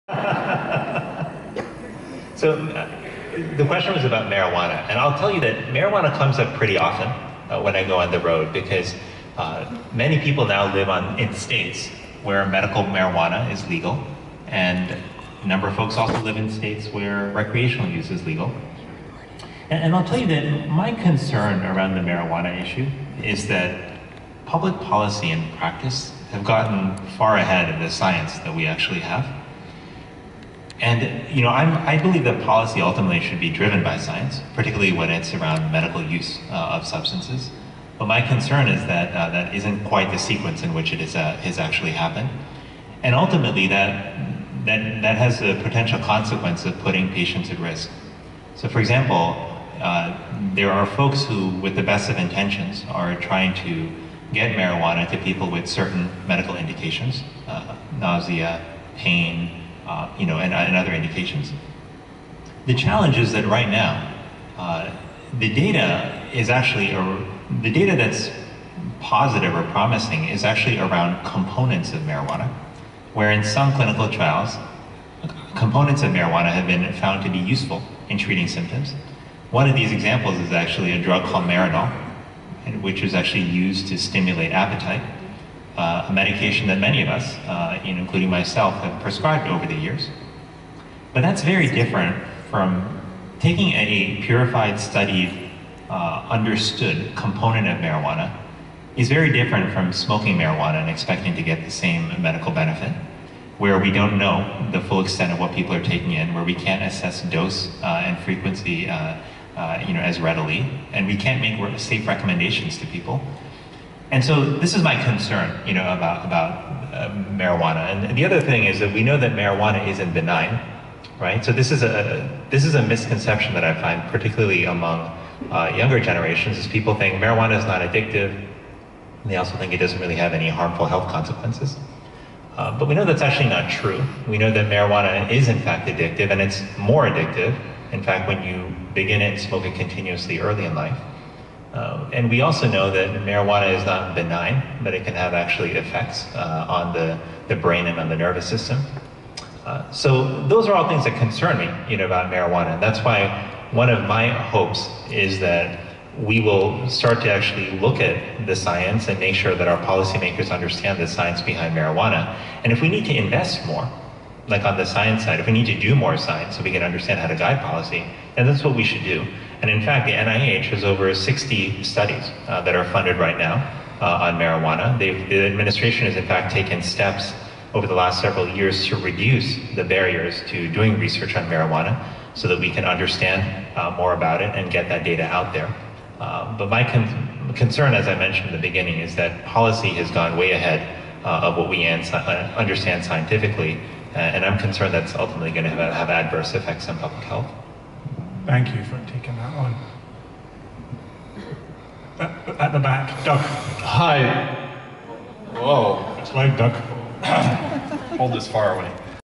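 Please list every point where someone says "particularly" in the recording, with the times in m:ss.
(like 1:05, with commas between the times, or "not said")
0:34, 2:04.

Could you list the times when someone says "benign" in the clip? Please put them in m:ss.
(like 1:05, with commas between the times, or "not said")
2:00, 2:24.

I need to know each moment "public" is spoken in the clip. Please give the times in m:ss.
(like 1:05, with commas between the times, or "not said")
0:24, 3:16.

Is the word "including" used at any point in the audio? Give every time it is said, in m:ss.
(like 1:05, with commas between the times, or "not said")
1:27.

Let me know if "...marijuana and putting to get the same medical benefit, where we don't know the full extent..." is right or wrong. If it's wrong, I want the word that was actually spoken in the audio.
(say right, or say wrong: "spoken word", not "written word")
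wrong: "expecting", not "putting".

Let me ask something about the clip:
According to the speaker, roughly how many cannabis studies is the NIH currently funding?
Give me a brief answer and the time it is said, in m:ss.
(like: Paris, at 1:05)
over 60, at 2:50.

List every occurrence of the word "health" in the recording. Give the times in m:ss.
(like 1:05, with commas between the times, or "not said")
2:10, 3:17.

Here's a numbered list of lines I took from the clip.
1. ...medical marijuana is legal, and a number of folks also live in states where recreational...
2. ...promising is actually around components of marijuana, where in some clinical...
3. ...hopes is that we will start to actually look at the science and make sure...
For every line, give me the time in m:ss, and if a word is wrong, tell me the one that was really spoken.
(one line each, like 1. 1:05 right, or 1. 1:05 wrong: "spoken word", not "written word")
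1. 0:12 right
2. 1:09 right
3. 2:34 right.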